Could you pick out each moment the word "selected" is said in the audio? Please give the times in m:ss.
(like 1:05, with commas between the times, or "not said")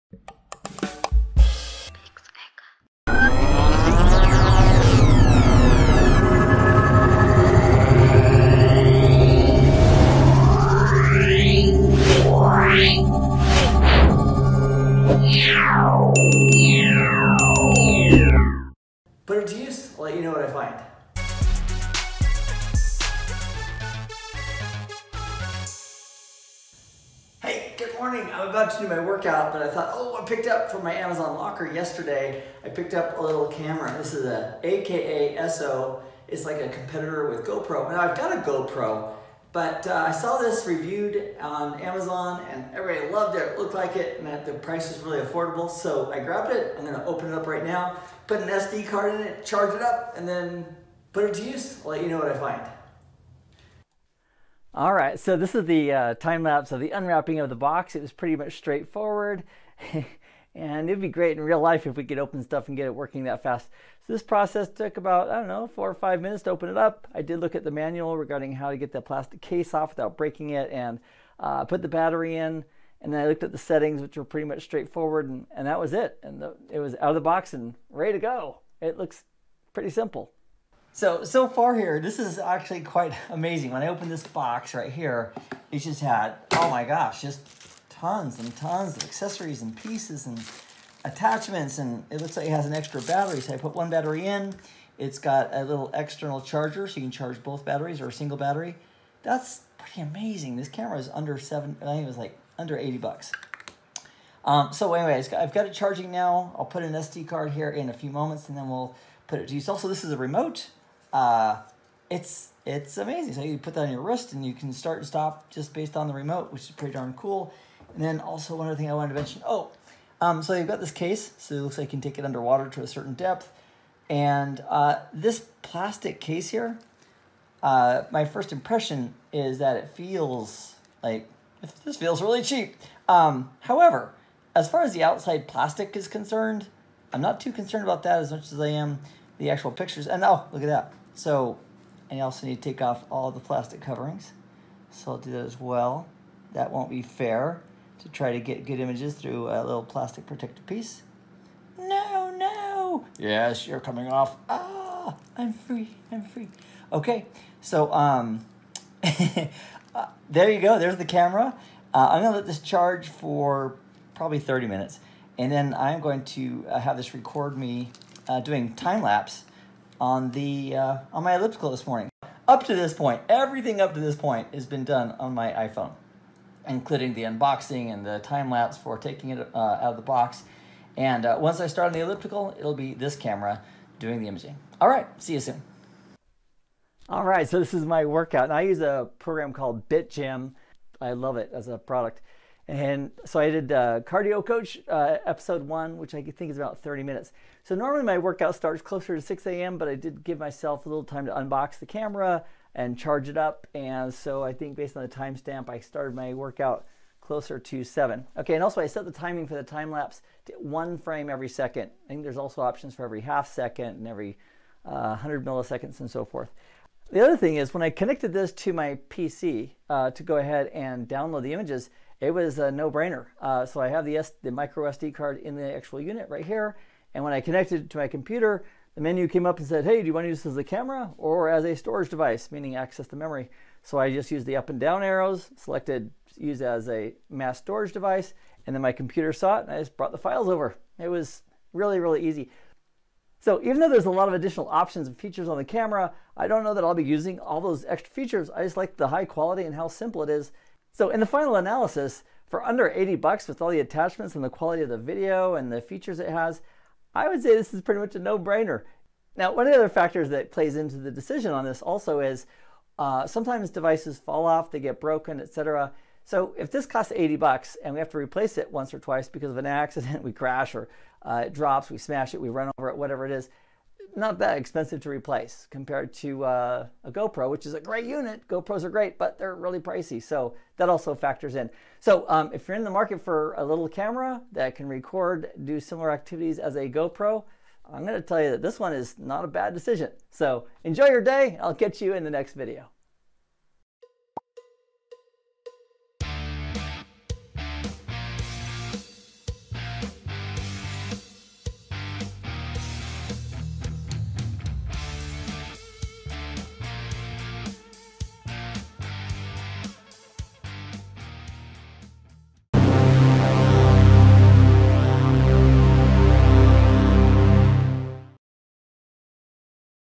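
3:55.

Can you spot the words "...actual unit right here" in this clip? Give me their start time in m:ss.
3:45.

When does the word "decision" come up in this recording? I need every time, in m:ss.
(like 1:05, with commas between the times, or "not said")
4:21, 4:49.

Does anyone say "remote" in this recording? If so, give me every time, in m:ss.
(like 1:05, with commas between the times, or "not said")
1:50, 1:56.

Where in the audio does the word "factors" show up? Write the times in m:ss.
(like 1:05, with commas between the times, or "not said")
4:19, 4:41.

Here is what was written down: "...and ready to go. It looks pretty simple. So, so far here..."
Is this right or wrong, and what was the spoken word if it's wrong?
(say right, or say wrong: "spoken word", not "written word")
right.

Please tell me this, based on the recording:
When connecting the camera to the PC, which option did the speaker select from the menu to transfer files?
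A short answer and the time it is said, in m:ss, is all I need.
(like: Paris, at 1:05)
Mass storage device, at 3:57.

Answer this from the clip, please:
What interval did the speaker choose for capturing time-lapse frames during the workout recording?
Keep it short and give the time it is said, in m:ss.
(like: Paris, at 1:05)
One frame every second, at 3:30.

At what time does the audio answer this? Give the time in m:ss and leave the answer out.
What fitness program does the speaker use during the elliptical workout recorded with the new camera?
3:09.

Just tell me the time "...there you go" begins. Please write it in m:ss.
2:40.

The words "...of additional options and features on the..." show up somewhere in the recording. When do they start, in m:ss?
4:04.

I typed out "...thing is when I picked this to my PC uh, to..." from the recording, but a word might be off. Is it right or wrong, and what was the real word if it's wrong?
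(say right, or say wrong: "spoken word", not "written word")
wrong: "connected", not "picked".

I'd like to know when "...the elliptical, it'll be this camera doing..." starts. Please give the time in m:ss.
3:01.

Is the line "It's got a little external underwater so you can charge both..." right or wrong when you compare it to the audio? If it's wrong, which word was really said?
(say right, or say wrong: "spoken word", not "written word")
wrong: "charger", not "underwater".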